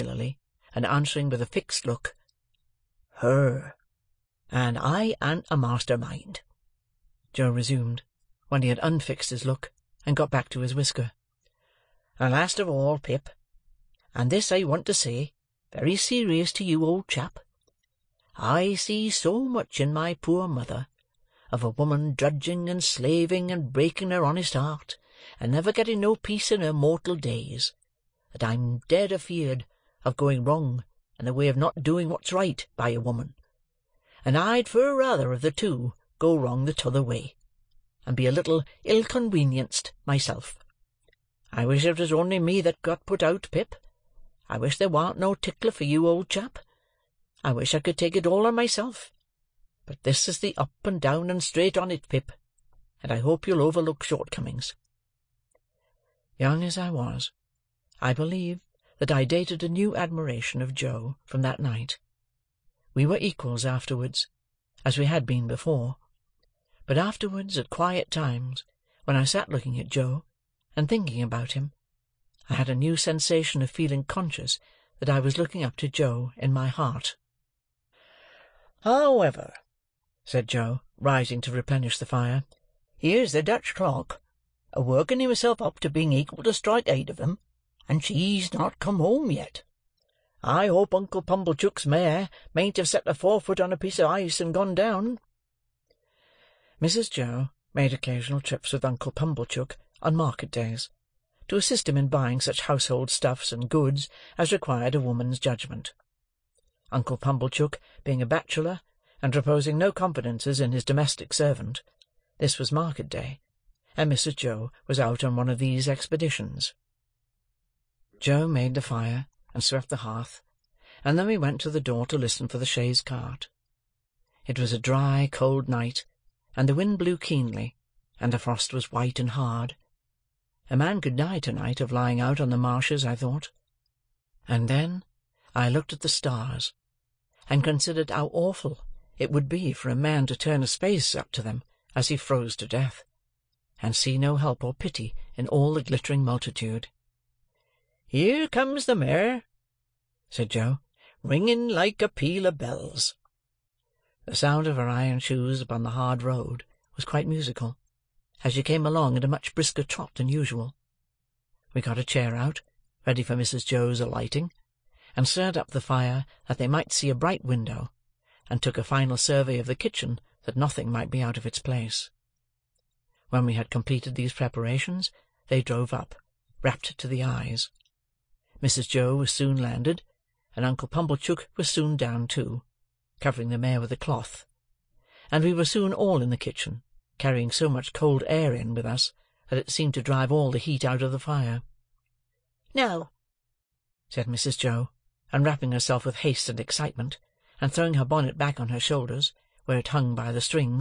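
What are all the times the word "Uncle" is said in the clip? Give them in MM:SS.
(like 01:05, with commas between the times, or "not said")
01:30, 01:38, 01:46, 03:00.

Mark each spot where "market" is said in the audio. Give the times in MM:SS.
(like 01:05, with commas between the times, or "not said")
01:40, 01:52.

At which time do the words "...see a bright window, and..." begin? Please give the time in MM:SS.
02:46.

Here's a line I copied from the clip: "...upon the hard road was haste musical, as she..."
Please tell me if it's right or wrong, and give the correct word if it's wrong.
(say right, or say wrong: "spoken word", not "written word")
wrong: "quite", not "haste".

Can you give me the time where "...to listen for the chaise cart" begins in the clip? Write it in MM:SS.
02:02.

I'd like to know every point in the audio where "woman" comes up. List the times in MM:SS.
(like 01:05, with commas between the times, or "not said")
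00:21, 00:33, 01:45.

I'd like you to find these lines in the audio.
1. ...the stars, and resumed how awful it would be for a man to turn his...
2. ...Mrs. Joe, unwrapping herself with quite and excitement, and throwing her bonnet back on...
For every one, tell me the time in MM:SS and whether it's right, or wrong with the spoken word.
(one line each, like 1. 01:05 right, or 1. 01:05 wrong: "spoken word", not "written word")
1. 02:16 wrong: "considered", not "resumed"
2. 03:14 wrong: "haste", not "quite".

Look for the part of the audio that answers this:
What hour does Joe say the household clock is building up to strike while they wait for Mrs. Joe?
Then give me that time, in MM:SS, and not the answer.
01:26.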